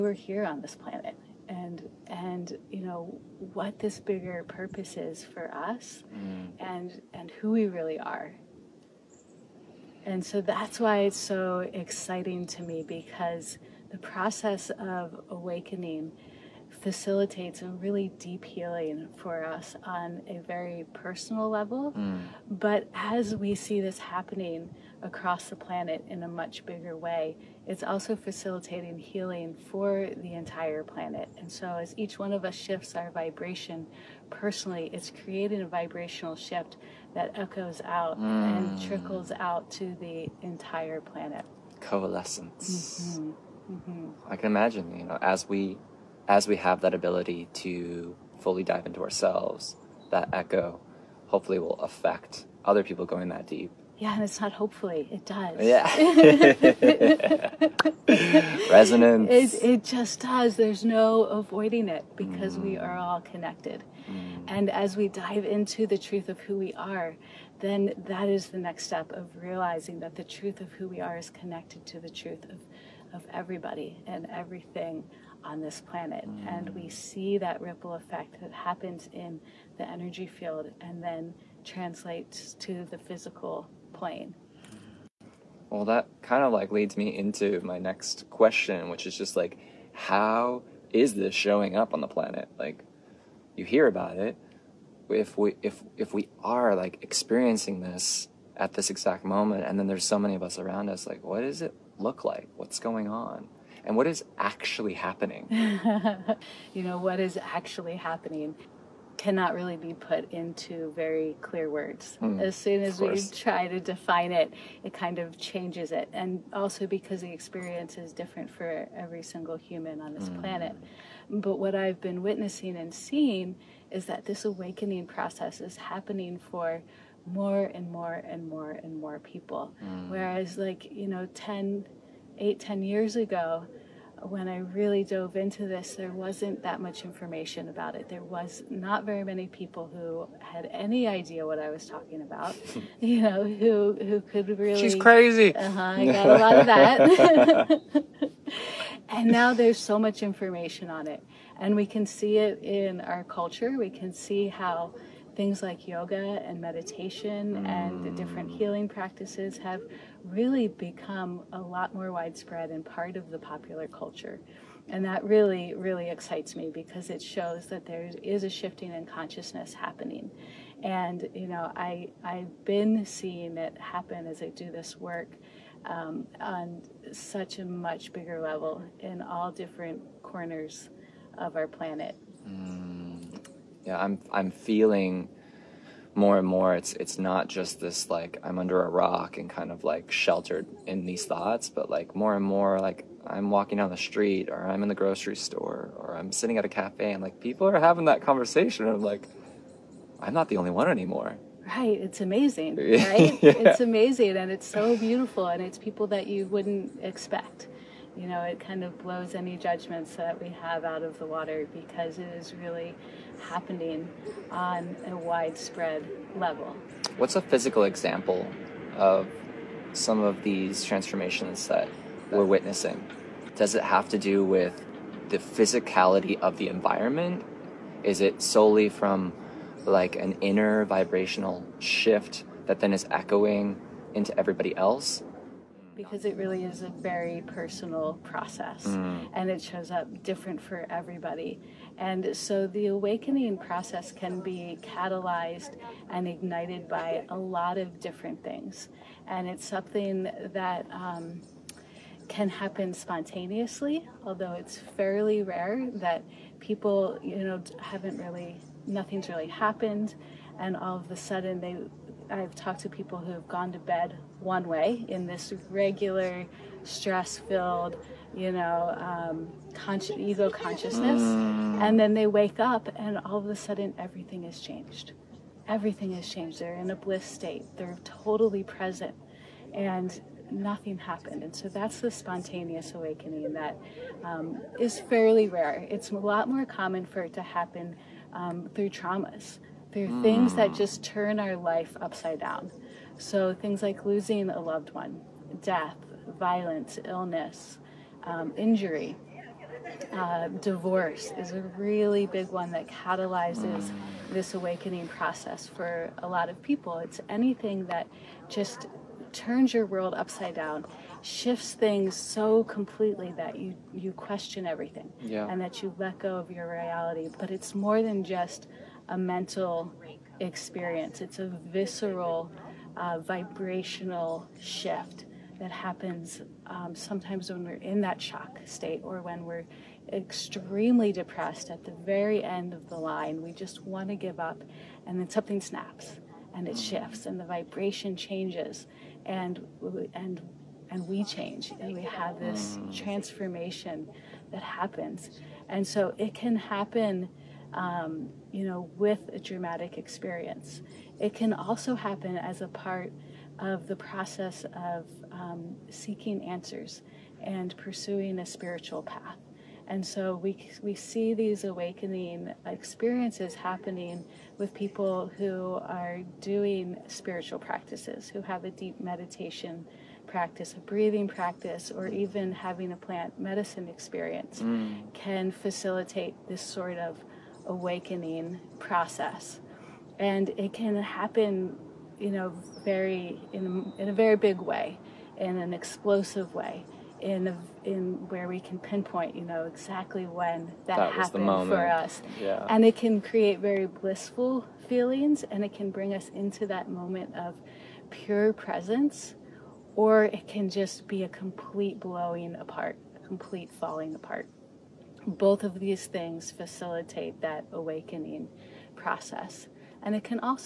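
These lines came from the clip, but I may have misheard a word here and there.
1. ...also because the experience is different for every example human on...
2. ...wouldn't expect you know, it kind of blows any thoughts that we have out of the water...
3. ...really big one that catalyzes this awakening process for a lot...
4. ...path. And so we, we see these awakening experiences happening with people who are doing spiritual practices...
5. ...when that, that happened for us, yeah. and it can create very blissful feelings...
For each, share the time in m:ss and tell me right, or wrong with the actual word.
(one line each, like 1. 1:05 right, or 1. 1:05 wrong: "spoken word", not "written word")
1. 1:56 wrong: "single", not "example"
2. 3:26 wrong: "judgments", not "thoughts"
3. 5:01 right
4. 5:59 right
5. 6:30 right.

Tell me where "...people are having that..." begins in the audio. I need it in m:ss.
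3:17.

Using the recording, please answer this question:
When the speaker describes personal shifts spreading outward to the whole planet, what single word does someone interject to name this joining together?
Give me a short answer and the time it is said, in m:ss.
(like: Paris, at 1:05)
Coalescence, at 0:41.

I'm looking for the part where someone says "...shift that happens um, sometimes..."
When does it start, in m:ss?
5:24.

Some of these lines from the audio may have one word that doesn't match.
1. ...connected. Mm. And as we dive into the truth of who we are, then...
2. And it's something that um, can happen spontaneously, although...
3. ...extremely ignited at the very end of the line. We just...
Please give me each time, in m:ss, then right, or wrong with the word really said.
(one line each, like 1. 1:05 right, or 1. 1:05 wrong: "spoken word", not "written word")
1. 1:03 right
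2. 4:09 right
3. 5:30 wrong: "depressed", not "ignited".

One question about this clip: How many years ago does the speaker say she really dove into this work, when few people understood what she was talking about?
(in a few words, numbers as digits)
10.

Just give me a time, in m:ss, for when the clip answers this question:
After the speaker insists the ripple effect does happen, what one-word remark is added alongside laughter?
0:58.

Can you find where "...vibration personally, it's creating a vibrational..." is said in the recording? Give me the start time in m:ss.
0:33.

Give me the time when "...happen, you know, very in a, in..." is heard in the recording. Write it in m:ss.
6:21.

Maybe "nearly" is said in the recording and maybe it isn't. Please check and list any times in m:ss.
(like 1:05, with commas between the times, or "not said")
not said.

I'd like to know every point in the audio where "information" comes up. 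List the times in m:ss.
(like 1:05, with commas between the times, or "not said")
2:17, 2:30.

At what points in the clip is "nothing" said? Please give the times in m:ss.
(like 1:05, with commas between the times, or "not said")
4:18, 4:40.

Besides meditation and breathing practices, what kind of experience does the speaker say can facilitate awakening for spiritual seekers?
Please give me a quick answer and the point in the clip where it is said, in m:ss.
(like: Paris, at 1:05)
plant medicine, at 6:12.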